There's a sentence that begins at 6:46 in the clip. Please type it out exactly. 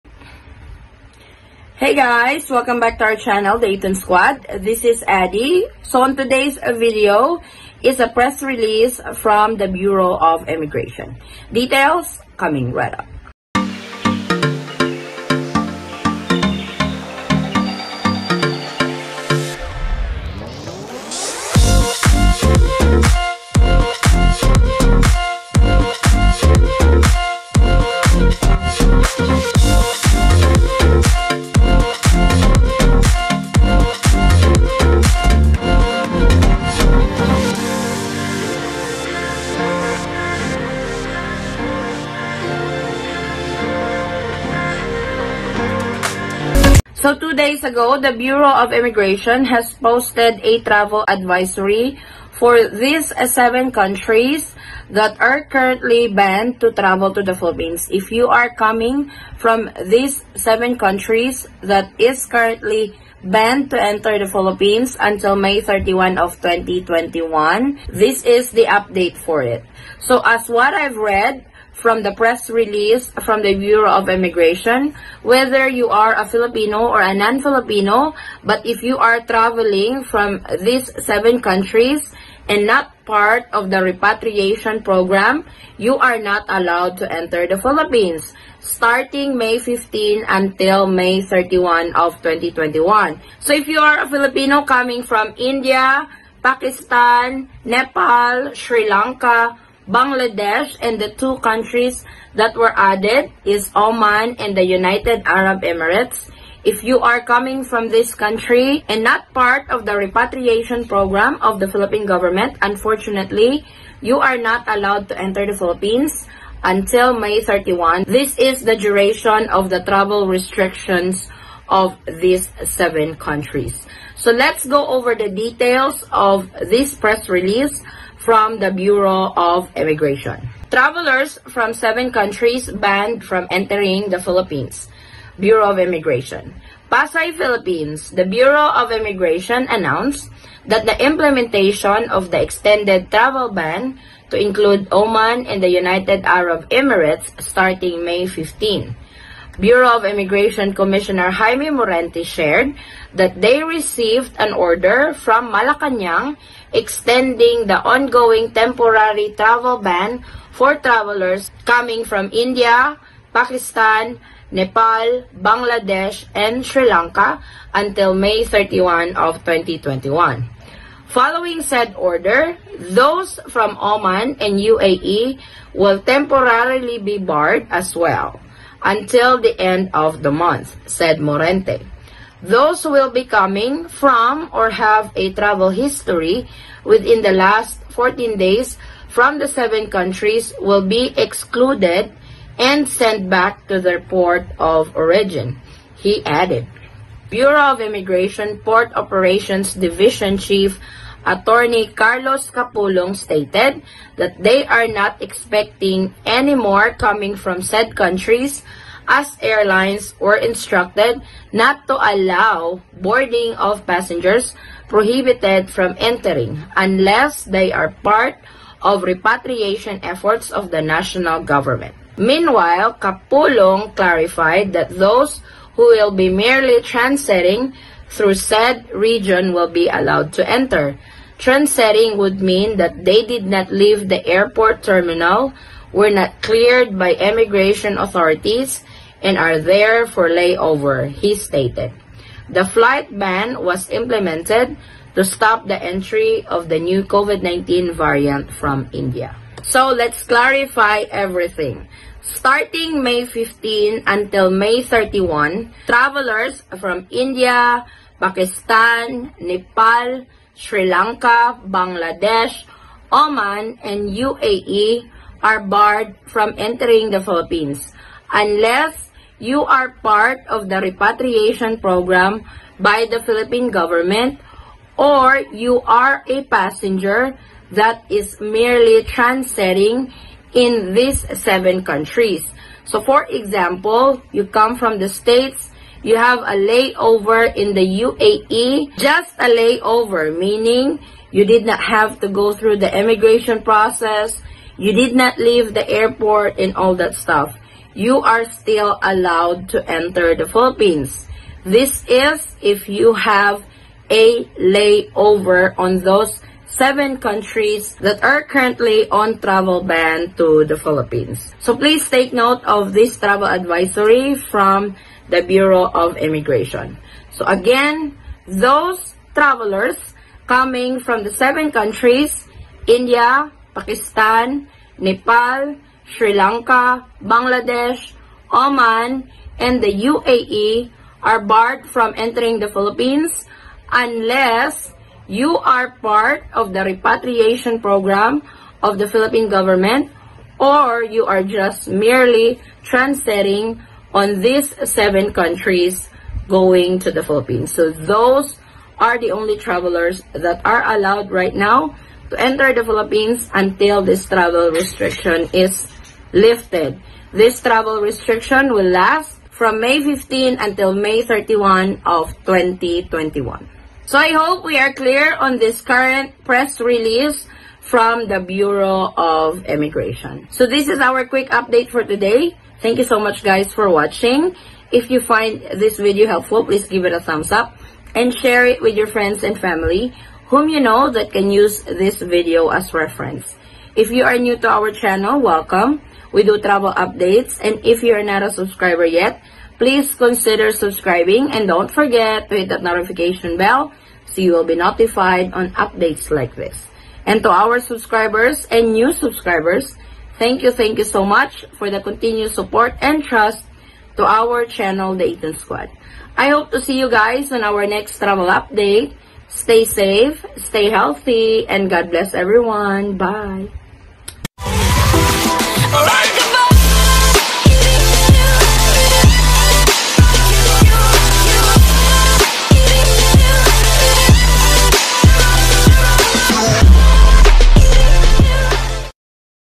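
I hope to see you guys on our next travel update.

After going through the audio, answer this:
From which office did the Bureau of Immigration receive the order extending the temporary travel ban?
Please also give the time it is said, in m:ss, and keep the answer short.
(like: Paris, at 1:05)
Malacanang, at 2:35.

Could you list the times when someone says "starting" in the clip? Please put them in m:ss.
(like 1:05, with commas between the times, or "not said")
1:28, 2:27, 4:12.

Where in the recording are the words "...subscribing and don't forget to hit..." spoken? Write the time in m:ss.
6:30.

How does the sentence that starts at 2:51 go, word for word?
Following said order, those from Oman and UAE will temporarily be barred as well.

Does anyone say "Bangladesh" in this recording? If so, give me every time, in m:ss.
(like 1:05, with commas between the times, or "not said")
1:39, 2:45, 4:21, 5:27.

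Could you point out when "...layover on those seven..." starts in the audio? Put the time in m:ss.
5:04.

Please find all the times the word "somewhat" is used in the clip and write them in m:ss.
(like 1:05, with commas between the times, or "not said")
not said.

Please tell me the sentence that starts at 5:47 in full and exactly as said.
So those are the only travelers that are allowed right now to enter the Philippines until this travel restriction is lifted.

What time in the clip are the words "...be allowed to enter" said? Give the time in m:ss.
3:49.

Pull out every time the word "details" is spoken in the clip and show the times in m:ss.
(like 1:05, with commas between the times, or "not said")
0:11, 2:05.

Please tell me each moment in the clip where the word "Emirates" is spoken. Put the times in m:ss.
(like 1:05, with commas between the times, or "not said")
1:45, 2:26.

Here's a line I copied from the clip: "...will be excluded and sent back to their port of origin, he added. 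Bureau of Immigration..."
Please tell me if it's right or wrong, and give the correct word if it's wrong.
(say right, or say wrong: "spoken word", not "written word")
right.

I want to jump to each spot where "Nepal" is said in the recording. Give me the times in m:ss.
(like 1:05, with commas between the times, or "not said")
1:37, 2:44, 4:19, 5:24.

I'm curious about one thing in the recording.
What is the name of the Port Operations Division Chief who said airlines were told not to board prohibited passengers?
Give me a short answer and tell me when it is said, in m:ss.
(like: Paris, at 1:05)
Carlos Capulong, at 3:21.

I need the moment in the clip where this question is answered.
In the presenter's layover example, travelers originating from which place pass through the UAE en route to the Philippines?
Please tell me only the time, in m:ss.
4:44.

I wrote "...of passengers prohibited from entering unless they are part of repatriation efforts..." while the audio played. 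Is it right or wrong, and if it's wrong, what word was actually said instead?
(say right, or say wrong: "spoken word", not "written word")
right.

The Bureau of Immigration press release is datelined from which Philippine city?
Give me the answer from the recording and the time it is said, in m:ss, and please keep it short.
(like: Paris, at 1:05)
Pasay, at 2:16.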